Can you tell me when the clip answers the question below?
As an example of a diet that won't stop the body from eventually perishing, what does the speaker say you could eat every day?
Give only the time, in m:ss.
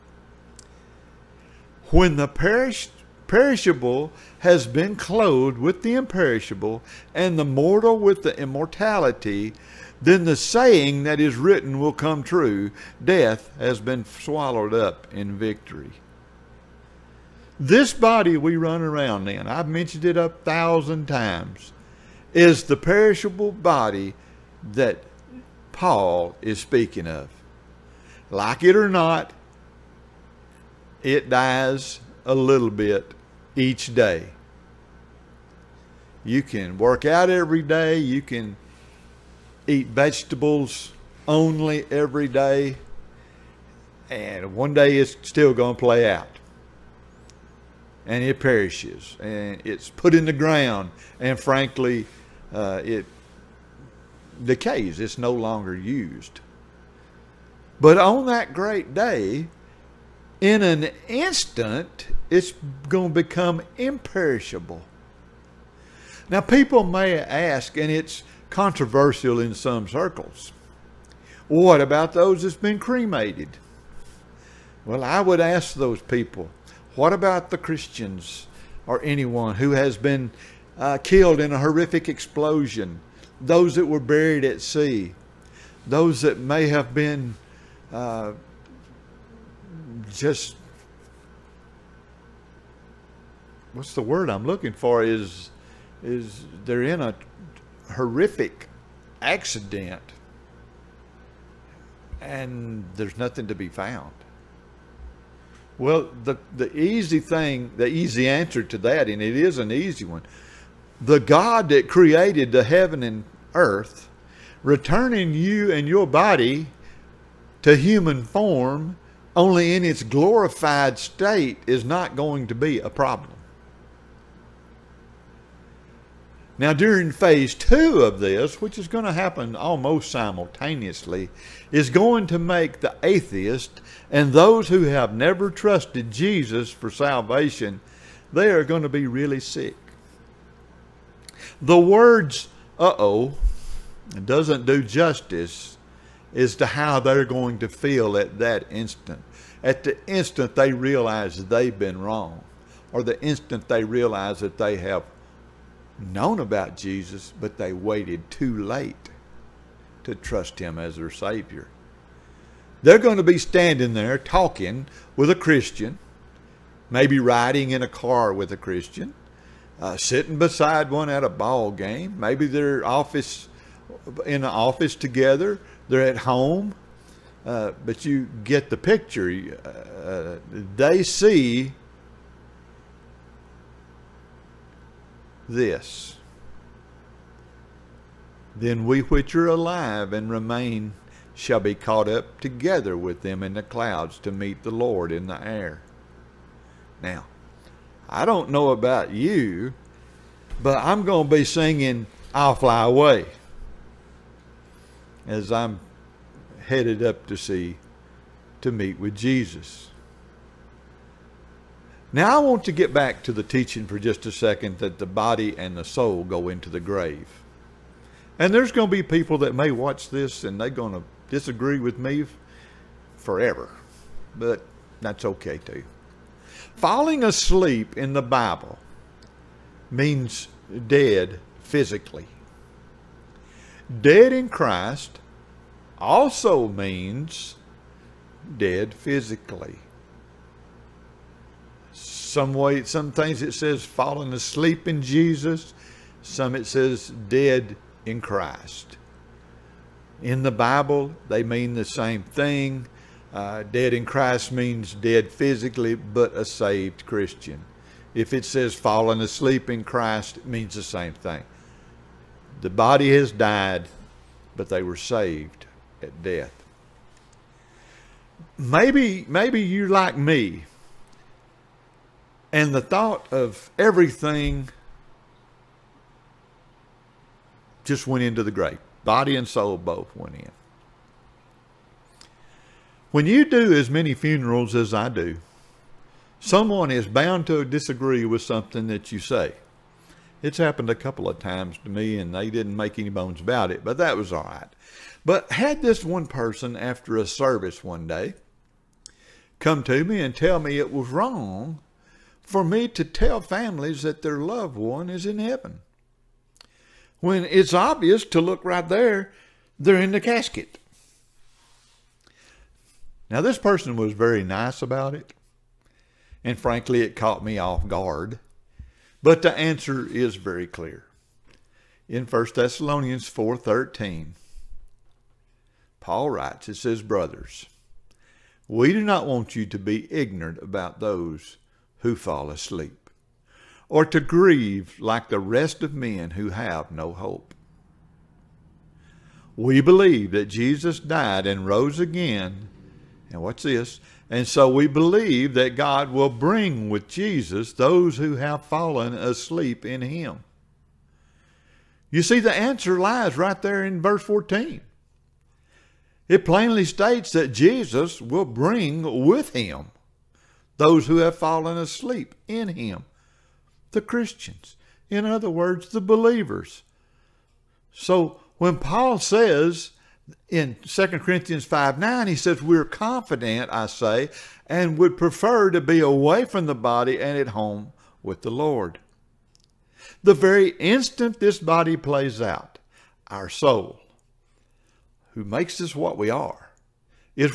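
0:39.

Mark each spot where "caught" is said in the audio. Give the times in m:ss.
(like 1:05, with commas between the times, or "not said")
3:11, 5:17.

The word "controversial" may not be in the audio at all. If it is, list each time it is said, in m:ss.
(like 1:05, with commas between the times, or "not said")
1:08.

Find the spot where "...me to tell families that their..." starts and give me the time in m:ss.
5:02.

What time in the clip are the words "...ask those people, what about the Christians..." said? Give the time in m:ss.
1:15.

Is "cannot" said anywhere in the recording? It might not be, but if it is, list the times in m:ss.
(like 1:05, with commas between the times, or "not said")
not said.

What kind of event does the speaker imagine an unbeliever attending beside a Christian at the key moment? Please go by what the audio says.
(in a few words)
a ball game.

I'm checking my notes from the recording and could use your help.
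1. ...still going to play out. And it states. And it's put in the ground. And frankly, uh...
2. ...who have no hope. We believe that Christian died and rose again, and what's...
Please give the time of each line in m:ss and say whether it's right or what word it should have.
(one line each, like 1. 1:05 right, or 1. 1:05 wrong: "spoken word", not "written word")
1. 0:45 wrong: "perishes", not "states"
2. 5:36 wrong: "Jesus", not "Christian".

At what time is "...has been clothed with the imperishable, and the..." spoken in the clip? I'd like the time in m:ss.
0:04.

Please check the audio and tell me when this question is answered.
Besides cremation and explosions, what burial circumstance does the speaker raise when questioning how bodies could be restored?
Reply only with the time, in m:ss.
1:24.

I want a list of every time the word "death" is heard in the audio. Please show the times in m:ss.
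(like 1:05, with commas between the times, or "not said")
0:13, 4:26.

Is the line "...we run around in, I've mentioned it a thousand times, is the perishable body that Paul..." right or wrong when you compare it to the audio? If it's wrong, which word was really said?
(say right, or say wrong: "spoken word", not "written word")
right.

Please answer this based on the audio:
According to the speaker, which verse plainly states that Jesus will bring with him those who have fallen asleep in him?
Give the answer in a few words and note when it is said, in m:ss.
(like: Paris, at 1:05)
verse 14, at 5:54.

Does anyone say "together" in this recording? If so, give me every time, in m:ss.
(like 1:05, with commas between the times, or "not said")
2:54, 3:12.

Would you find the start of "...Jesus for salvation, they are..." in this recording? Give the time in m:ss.
2:16.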